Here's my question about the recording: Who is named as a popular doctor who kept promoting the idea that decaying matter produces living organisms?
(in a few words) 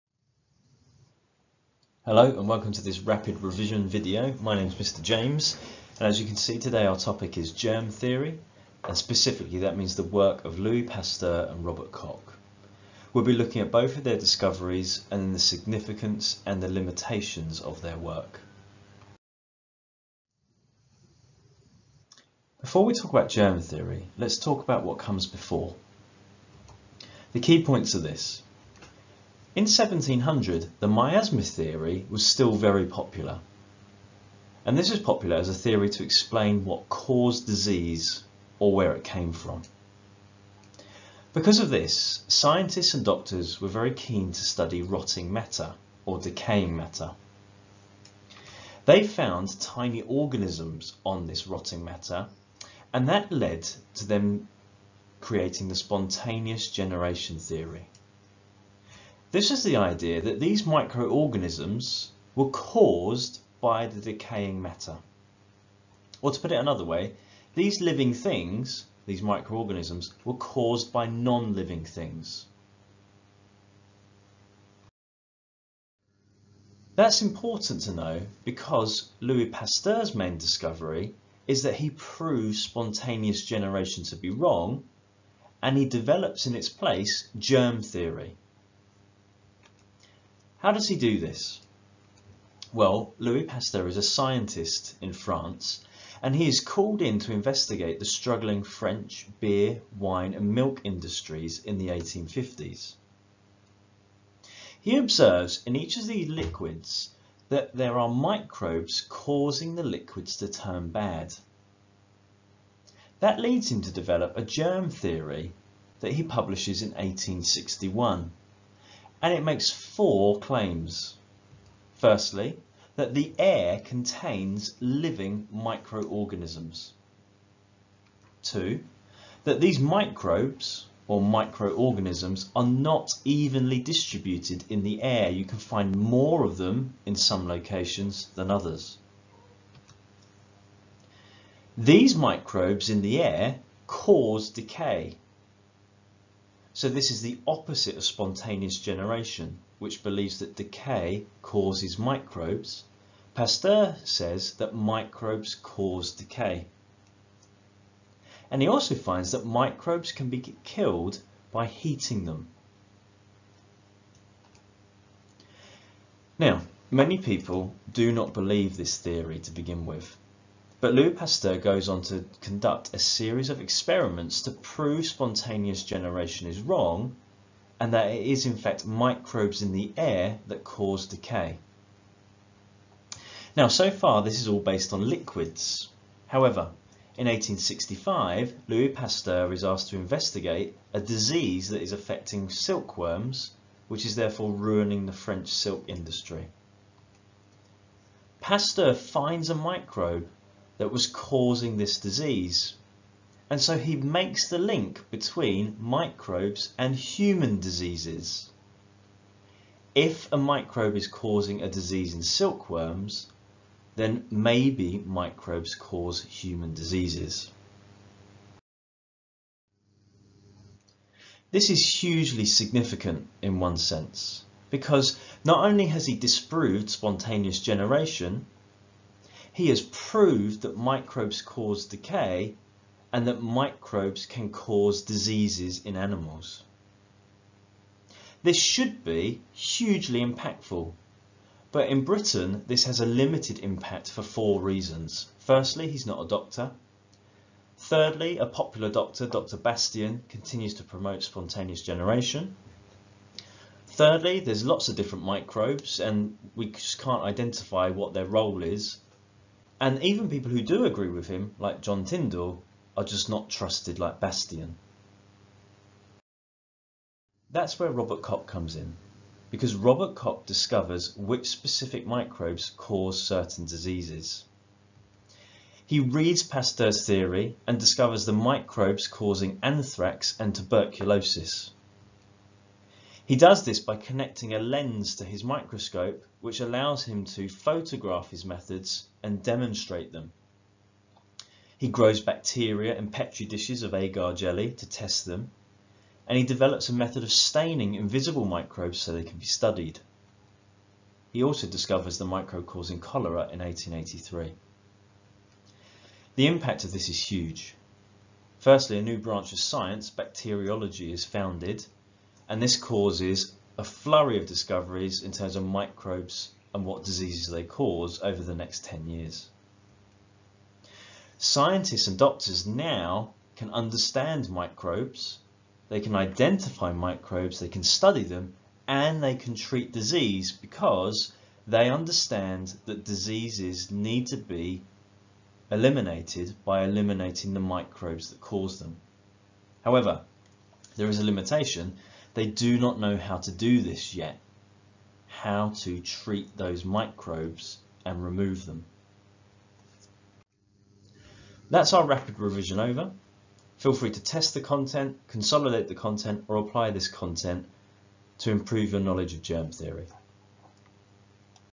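Dr. Bastian.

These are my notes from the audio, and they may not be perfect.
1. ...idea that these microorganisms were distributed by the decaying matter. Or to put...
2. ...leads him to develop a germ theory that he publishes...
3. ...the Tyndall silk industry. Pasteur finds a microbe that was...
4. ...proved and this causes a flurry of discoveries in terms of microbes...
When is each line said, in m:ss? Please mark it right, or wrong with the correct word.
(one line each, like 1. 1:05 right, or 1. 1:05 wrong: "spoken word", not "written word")
1. 0:59 wrong: "caused", not "distributed"
2. 1:53 right
3. 3:15 wrong: "French", not "Tyndall"
4. 5:11 wrong: "founded", not "proved".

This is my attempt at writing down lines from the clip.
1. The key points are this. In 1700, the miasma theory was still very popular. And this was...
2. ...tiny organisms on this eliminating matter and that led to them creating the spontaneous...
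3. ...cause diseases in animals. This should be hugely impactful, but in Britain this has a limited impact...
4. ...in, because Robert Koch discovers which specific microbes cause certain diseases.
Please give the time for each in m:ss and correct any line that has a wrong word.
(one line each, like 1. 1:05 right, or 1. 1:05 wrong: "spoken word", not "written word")
1. 0:27 right
2. 0:49 wrong: "rotting", not "eliminating"
3. 3:54 right
4. 4:28 right.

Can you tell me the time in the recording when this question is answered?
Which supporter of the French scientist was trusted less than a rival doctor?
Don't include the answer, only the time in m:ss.
4:21.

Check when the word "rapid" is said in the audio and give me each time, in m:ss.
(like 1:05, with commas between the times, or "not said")
0:03, 5:52.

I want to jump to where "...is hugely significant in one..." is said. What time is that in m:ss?
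3:41.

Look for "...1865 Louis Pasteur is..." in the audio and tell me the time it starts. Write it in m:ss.
3:07.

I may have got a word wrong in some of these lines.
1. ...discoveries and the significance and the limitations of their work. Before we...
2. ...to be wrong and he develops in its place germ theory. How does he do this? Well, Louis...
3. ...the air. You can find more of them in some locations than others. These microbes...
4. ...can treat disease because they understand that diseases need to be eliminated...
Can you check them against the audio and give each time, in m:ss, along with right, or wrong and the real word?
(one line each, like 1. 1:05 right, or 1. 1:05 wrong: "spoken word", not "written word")
1. 0:14 right
2. 1:24 right
3. 2:14 right
4. 5:29 right.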